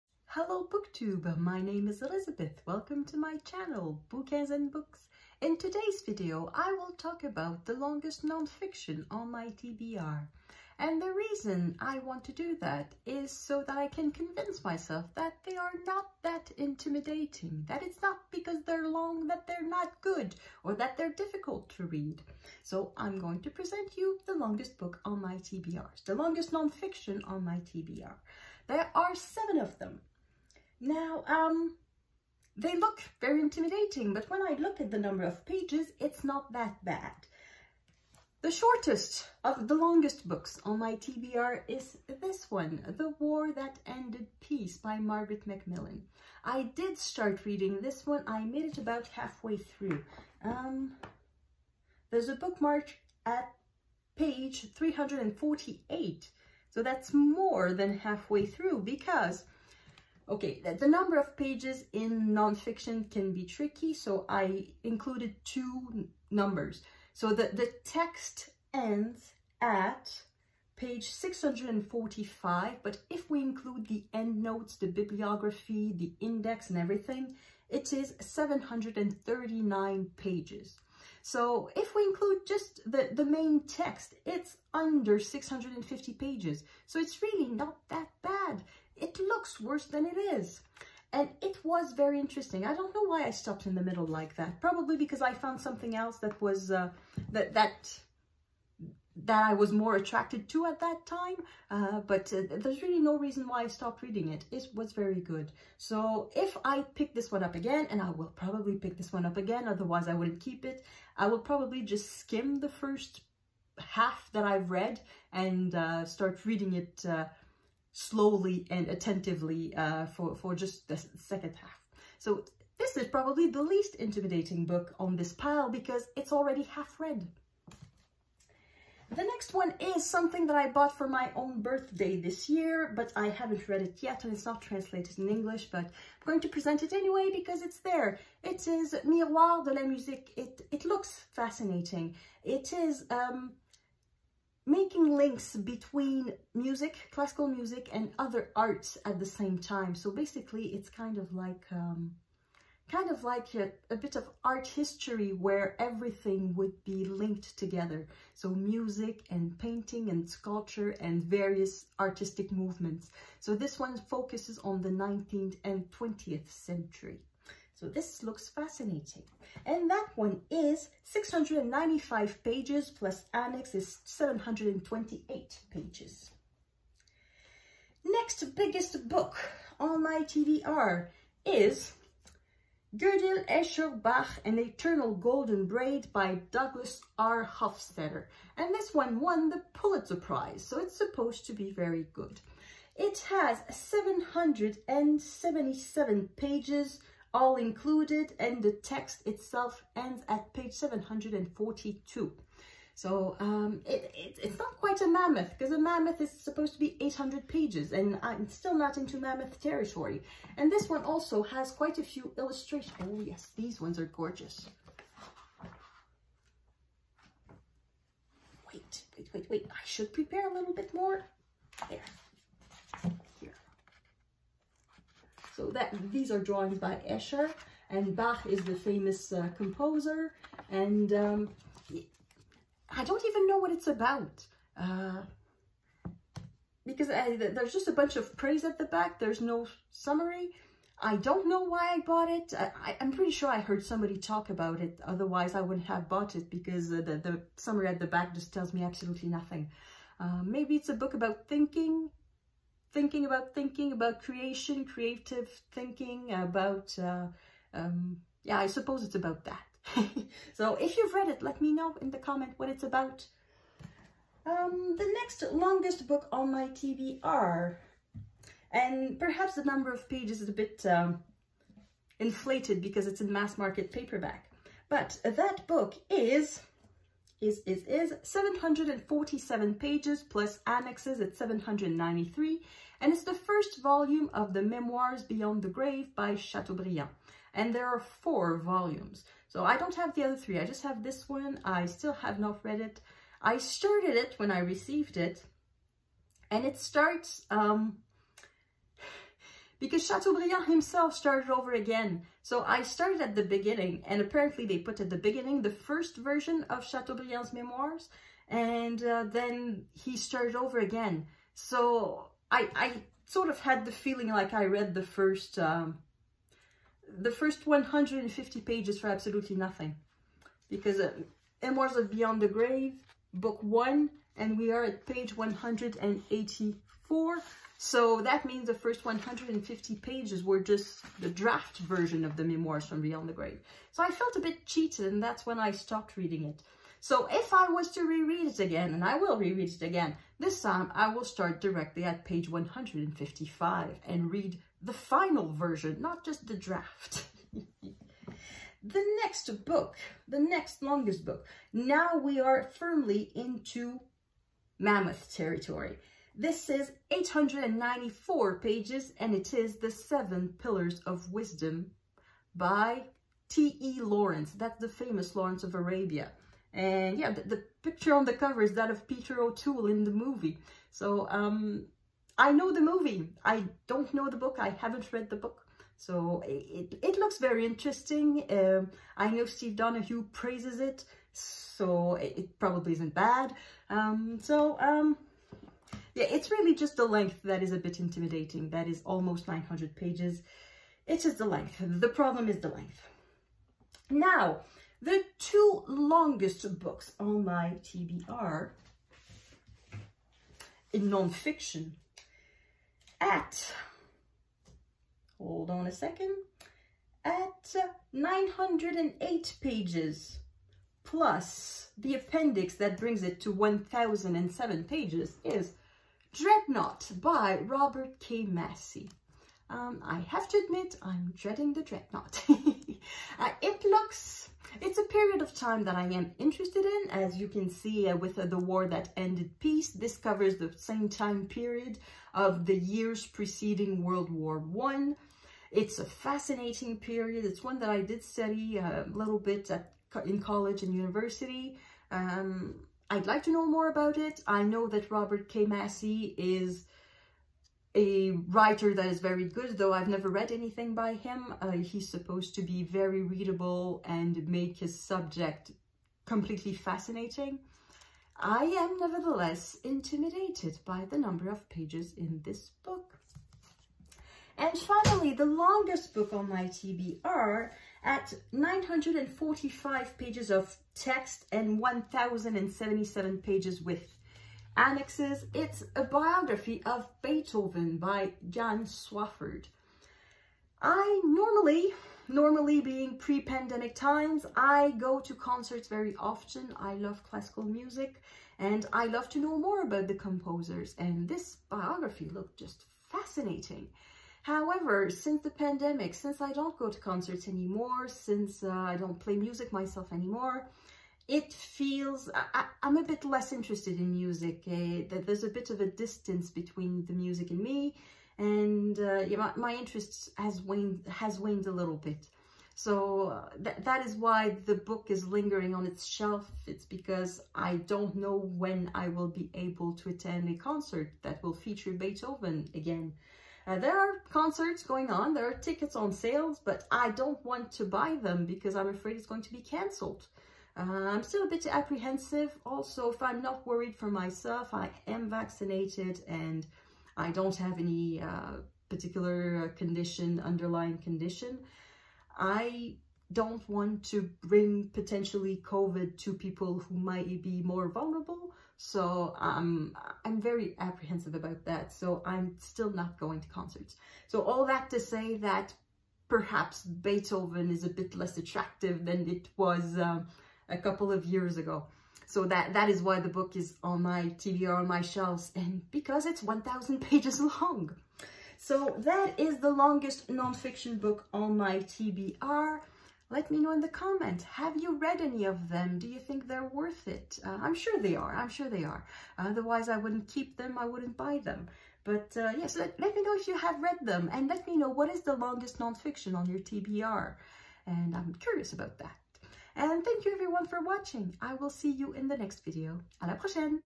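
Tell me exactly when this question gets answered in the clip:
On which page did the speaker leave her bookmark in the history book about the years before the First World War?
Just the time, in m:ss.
0:54.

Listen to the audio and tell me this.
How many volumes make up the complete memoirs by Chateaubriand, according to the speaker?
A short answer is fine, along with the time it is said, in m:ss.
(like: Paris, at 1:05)
4, at 4:47.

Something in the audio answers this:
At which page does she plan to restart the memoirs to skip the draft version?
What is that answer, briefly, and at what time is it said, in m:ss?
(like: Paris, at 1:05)
155, at 5:42.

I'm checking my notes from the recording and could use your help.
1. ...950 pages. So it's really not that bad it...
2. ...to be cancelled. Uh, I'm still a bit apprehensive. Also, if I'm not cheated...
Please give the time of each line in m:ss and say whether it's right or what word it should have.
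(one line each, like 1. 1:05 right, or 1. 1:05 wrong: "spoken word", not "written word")
1. 1:25 wrong: "650", not "950"
2. 8:49 wrong: "worried", not "cheated".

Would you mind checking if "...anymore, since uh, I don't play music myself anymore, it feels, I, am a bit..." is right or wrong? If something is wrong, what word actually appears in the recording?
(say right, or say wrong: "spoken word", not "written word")
right.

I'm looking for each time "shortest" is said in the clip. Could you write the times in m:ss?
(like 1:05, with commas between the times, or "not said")
0:38.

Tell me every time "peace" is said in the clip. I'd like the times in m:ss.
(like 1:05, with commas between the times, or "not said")
0:44, 7:09.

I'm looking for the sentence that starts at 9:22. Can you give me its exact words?
So that, that is why the book is on my TBR, on my shelves, and because it's 1,000 pages long.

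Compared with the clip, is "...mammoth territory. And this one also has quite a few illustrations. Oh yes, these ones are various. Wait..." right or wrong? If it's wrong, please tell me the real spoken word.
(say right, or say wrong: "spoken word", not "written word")
wrong: "gorgeous", not "various".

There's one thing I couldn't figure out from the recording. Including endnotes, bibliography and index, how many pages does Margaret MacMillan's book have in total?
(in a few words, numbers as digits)
739.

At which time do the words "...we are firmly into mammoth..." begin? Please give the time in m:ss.
5:52.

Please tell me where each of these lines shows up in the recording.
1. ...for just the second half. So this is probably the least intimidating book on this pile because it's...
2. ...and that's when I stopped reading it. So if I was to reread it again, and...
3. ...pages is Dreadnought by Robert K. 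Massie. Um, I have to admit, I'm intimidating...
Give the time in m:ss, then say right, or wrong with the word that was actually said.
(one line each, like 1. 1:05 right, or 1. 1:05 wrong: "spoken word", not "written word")
1. 2:00 right
2. 5:35 right
3. 6:54 wrong: "dreading", not "intimidating".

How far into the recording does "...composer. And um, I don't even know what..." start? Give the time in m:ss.
3:49.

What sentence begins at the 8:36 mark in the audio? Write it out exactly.
It's because I don't know when I will be able to attend a concert that will feature Beethoven again.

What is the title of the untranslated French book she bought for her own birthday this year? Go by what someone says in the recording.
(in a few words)
Miroirs de la Musique.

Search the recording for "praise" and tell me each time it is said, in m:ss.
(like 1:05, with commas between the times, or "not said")
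3:58, 6:20.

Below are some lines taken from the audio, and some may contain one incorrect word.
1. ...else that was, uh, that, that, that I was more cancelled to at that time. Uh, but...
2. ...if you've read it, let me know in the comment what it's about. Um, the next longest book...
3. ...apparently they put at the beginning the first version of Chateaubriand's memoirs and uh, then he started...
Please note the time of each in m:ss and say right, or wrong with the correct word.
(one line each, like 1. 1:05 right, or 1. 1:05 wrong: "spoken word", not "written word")
1. 1:35 wrong: "attracted", not "cancelled"
2. 4:20 right
3. 5:04 right.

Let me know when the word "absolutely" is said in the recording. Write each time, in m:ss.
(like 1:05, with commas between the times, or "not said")
4:08, 5:19.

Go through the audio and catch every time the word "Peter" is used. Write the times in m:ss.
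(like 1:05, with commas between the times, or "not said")
6:09.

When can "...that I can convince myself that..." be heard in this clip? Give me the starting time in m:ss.
0:13.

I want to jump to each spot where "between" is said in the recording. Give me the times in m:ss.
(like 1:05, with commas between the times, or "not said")
2:25, 8:26.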